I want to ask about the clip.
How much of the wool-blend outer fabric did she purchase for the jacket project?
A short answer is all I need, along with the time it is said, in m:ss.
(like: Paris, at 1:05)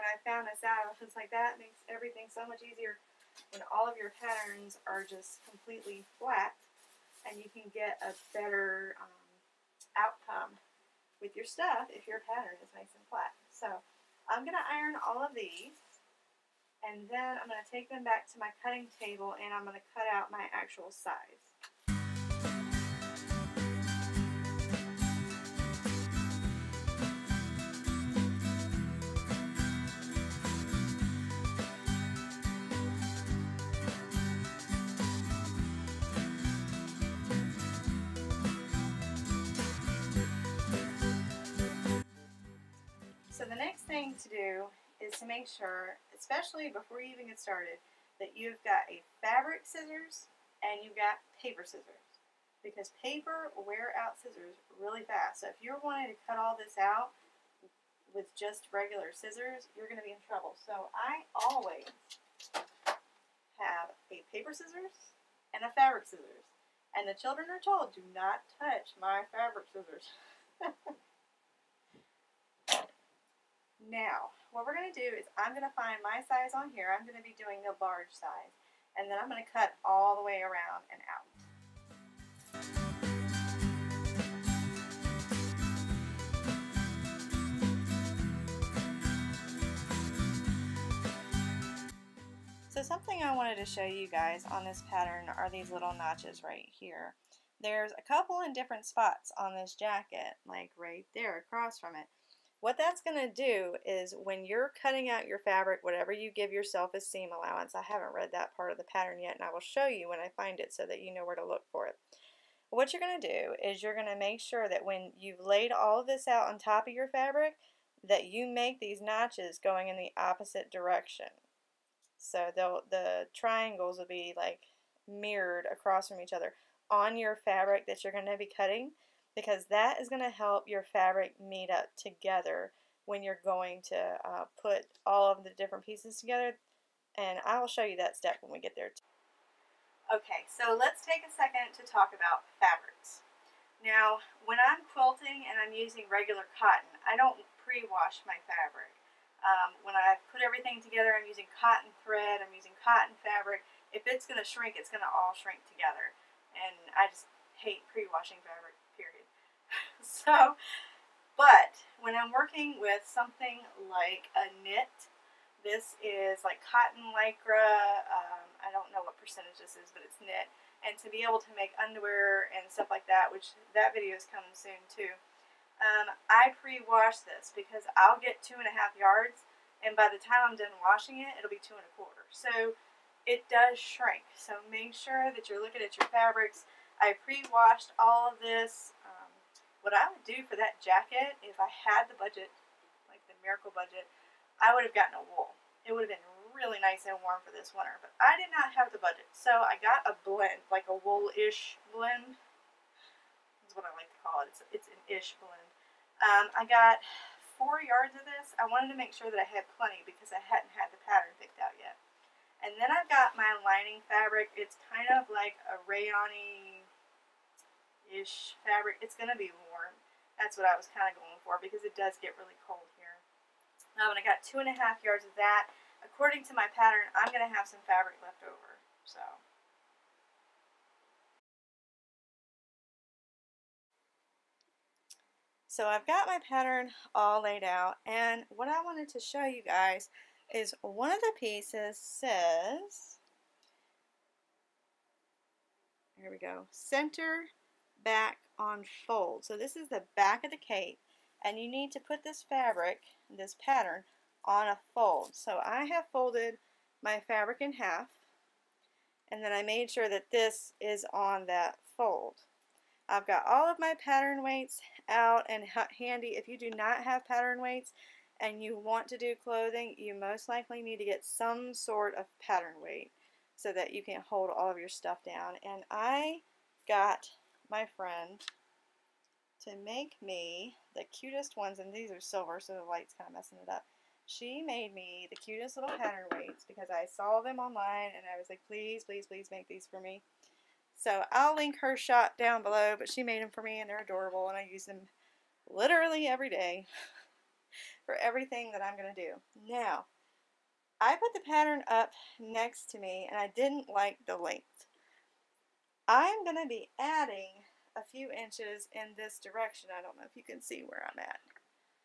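4 yards, at 3:27.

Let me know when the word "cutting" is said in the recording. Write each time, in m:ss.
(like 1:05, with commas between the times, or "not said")
0:18, 1:44, 2:08.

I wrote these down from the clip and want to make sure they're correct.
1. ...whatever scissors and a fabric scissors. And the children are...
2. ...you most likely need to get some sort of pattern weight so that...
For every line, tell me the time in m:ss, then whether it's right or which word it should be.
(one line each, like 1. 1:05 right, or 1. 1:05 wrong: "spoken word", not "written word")
1. 1:04 wrong: "paper", not "whatever"
2. 4:29 right.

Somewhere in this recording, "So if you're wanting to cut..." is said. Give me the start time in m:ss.
0:55.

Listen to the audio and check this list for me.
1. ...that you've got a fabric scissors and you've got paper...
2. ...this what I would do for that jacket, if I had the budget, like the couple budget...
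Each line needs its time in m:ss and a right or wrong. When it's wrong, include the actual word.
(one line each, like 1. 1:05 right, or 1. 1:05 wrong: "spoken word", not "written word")
1. 0:48 right
2. 3:08 wrong: "miracle", not "couple".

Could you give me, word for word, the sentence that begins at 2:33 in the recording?
If it's going to shrink, it's going to all shrink together.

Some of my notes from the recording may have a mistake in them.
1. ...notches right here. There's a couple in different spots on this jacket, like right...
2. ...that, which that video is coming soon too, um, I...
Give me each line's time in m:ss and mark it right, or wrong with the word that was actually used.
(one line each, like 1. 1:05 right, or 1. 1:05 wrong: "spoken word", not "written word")
1. 1:35 right
2. 2:53 right.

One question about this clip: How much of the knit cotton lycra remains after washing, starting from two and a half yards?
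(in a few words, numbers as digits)
2 and a quarter yards.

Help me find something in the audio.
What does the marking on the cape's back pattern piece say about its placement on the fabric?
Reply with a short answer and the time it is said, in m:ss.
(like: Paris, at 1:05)
center back on fold, at 4:06.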